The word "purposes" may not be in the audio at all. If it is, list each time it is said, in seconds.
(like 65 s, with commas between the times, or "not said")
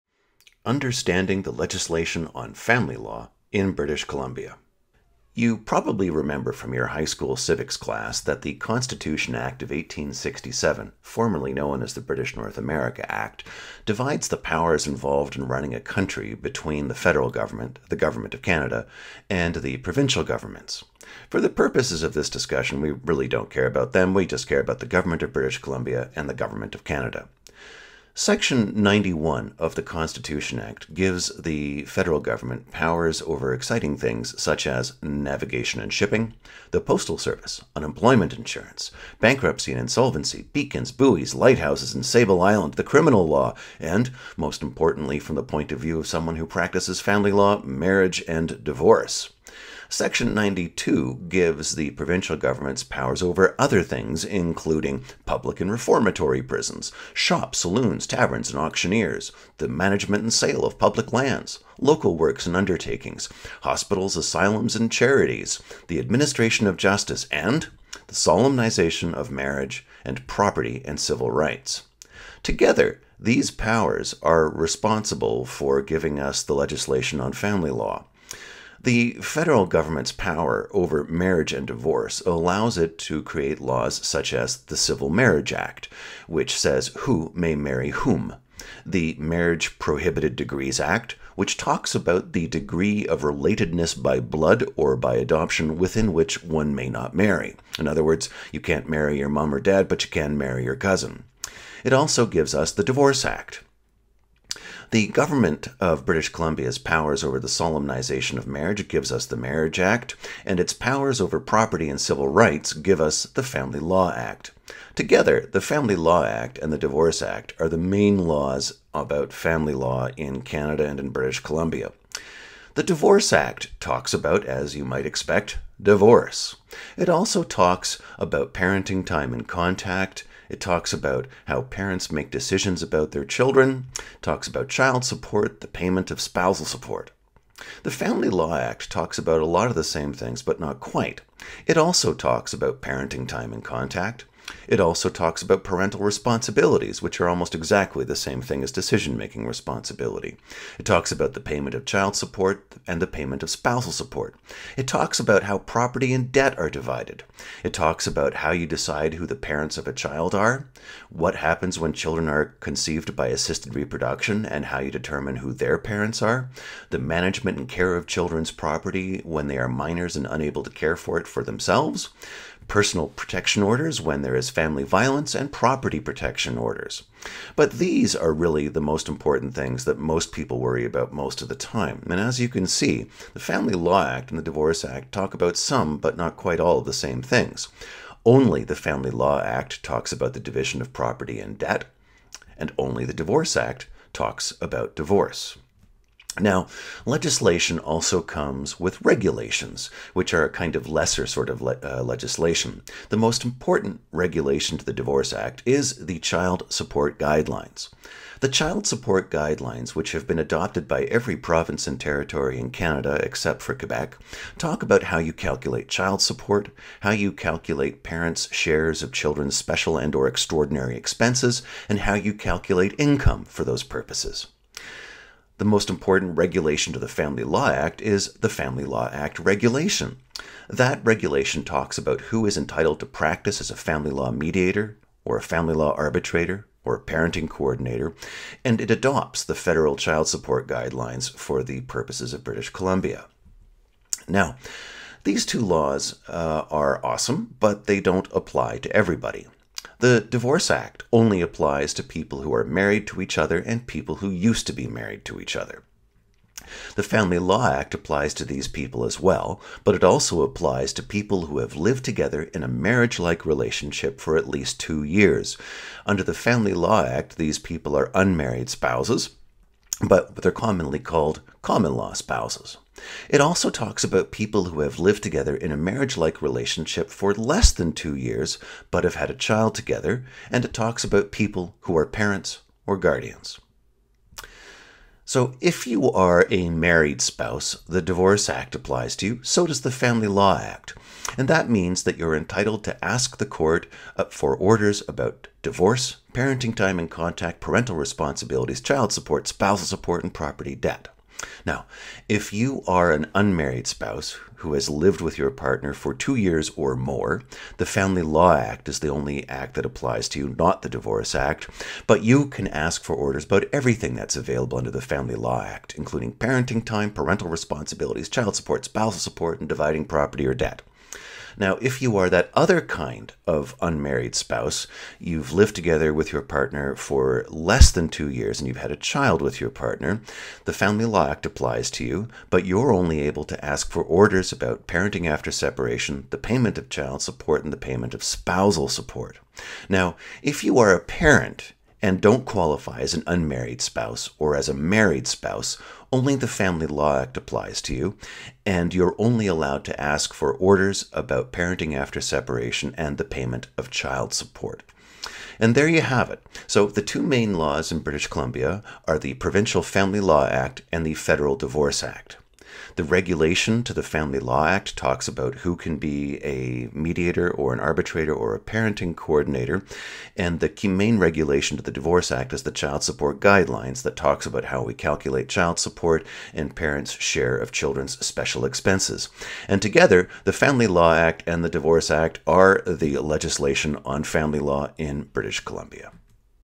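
21 s, 223 s, 241 s.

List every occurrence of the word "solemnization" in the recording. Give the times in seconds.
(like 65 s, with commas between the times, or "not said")
68 s, 107 s.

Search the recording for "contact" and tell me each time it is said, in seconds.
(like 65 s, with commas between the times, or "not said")
129 s, 143 s, 297 s.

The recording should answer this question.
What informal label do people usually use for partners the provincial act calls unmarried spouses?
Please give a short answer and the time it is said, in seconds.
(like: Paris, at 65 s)
common law spouses, at 271 s.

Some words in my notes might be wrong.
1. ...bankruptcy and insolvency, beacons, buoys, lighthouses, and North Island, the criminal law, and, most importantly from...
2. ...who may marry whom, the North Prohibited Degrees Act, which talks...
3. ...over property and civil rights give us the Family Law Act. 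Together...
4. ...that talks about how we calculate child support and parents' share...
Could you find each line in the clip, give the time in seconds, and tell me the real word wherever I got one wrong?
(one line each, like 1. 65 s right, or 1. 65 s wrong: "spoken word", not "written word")
1. 39 s wrong: "Sable", not "North"
2. 87 s wrong: "Marriage", not "North"
3. 111 s right
4. 374 s right.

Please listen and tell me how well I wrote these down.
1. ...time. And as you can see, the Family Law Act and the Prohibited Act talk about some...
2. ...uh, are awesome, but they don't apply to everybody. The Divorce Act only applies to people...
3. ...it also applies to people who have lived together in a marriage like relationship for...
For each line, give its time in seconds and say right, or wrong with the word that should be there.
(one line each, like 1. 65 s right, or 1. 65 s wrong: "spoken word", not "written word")
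1. 181 s wrong: "Divorce", not "Prohibited"
2. 246 s right
3. 259 s right.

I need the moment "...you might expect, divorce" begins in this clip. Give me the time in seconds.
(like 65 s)
124 s.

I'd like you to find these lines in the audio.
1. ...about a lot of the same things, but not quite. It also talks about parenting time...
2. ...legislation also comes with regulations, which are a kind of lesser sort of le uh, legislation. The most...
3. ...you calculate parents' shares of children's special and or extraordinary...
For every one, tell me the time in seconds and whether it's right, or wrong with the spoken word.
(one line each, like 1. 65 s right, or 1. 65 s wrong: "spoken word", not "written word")
1. 139 s right
2. 197 s right
3. 217 s right.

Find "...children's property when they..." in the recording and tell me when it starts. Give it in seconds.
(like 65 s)
168 s.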